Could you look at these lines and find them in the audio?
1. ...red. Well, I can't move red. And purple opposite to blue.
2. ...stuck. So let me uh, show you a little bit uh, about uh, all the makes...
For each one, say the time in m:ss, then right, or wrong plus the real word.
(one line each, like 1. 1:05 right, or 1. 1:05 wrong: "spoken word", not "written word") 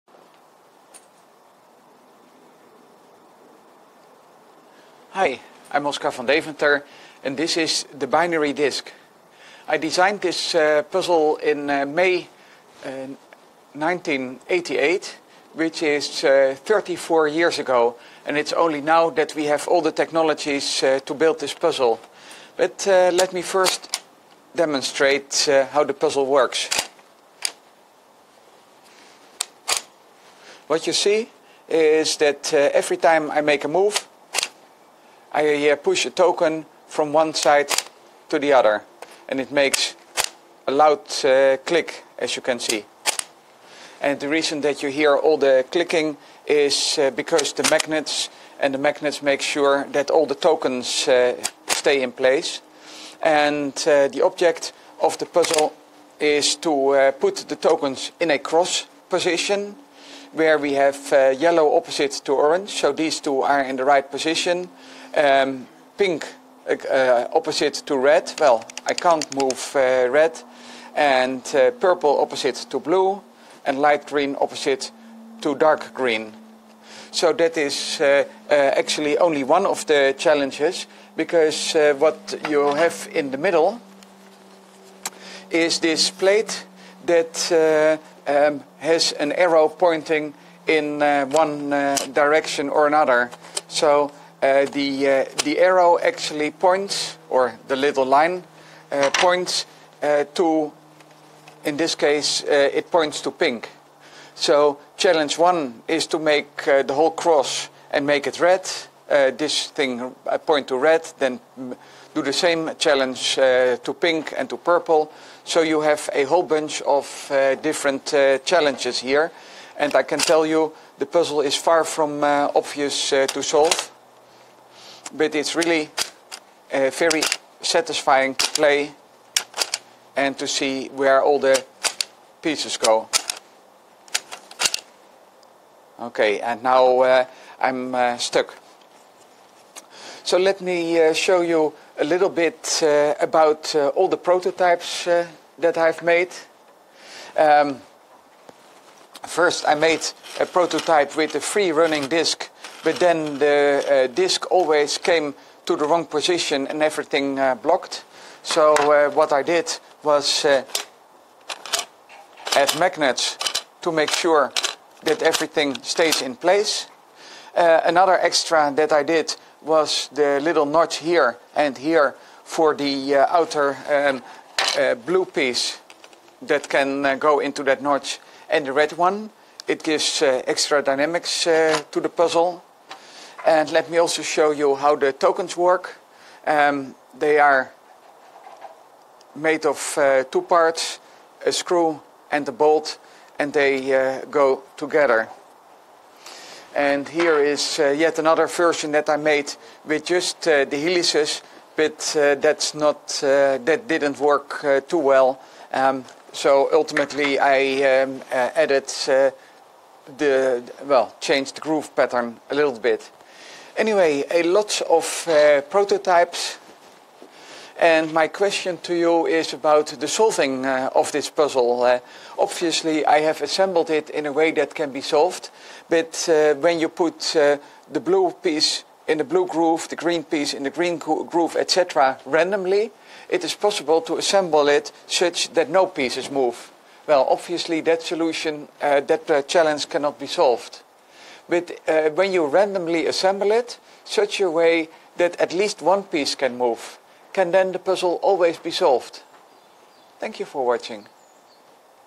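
1. 1:07 right
2. 2:18 wrong: "prototypes", not "makes".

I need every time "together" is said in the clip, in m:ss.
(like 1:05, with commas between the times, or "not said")
3:14.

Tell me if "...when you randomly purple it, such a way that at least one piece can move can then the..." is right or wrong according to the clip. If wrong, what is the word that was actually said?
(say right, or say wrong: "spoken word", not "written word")
wrong: "assemble", not "purple".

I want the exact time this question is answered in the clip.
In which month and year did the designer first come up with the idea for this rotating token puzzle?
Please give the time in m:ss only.
0:11.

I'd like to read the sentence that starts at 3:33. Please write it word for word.
Anyway, a lot of prototypes and my question to you is about the solving uh, of this puzzle.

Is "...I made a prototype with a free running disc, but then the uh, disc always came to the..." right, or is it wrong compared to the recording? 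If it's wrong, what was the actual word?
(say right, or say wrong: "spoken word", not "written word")
right.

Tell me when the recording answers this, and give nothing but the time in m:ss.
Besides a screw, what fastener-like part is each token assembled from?
3:12.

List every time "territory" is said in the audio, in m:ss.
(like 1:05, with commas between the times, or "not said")
not said.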